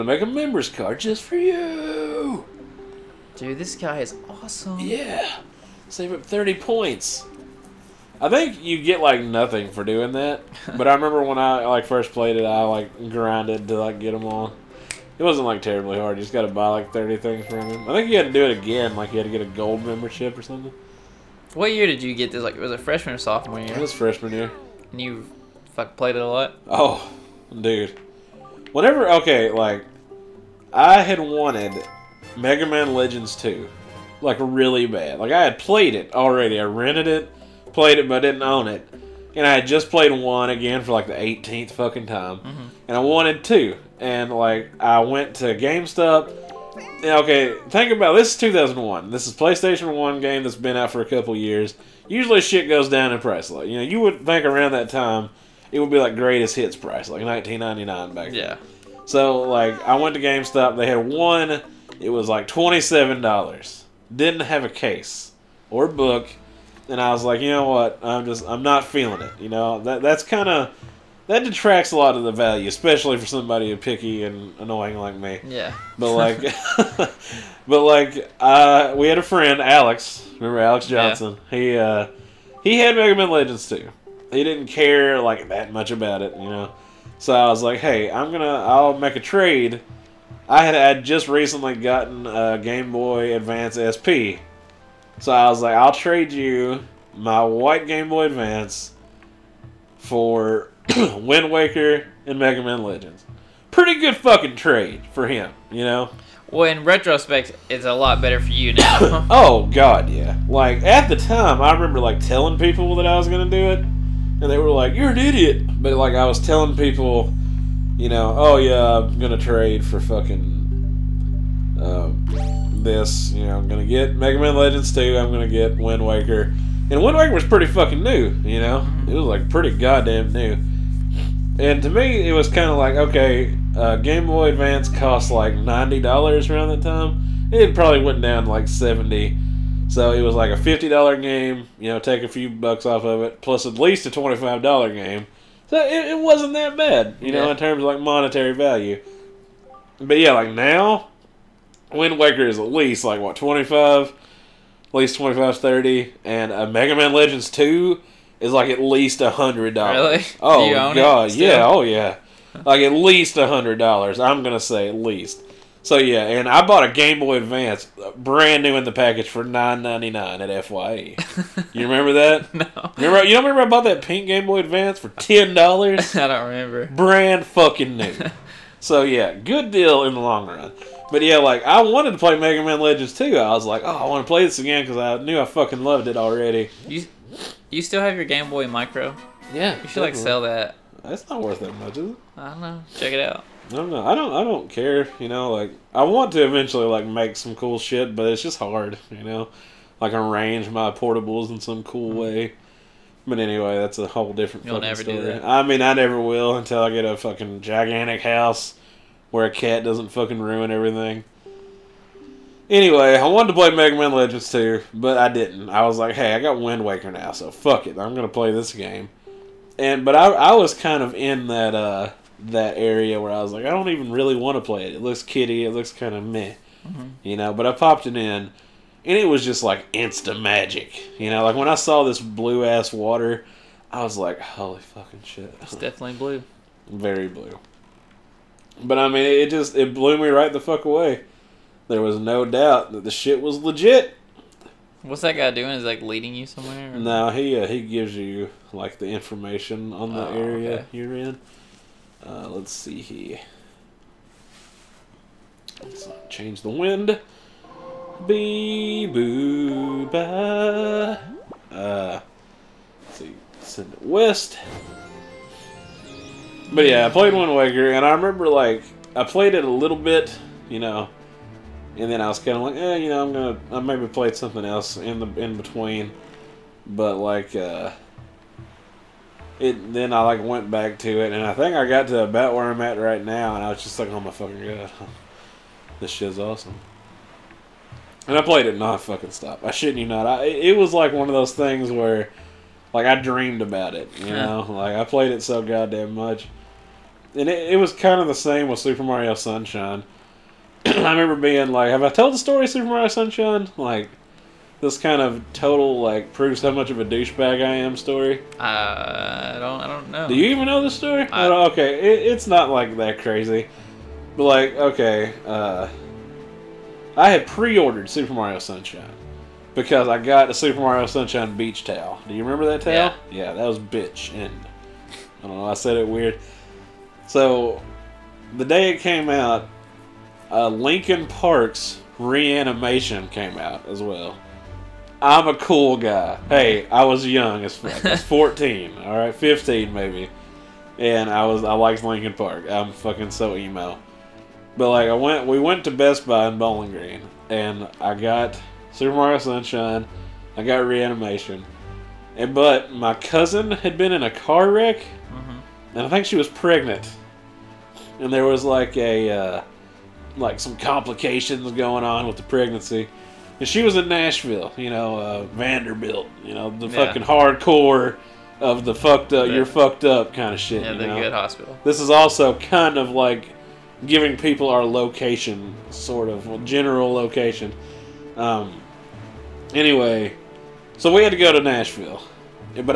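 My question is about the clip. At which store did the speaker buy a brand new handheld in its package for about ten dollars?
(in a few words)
FYE.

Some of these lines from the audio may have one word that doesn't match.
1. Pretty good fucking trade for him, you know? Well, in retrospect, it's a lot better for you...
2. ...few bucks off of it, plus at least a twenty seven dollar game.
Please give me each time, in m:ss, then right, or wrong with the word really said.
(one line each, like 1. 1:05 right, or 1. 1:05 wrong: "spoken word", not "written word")
1. 1:43 right
2. 2:22 wrong: "five", not "seven".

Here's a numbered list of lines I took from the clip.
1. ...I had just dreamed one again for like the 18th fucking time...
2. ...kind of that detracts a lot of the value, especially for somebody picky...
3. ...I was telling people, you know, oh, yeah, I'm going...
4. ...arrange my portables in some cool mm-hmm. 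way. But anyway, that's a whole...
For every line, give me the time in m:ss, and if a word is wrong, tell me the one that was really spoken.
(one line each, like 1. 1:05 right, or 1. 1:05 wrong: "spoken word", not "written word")
1. 0:39 wrong: "played", not "dreamed"
2. 1:10 right
3. 1:56 right
4. 3:20 right.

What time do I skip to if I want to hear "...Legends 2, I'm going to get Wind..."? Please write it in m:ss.
2:04.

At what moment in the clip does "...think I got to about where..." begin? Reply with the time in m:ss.
4:41.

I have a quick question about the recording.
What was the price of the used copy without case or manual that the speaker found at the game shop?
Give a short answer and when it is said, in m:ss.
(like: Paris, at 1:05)
$27, at 1:02.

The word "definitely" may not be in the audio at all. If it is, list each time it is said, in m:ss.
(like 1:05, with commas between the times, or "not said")
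3:09, 3:55.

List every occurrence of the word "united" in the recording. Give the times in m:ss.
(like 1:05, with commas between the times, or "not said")
not said.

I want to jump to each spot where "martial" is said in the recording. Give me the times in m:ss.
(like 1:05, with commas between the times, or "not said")
not said.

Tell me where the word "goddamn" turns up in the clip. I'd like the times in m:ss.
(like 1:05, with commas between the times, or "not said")
2:09, 4:55.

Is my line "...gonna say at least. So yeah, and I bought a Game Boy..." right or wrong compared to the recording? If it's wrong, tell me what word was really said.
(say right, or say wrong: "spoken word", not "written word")
right.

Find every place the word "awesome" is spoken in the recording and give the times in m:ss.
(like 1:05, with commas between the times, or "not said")
0:04, 4:46.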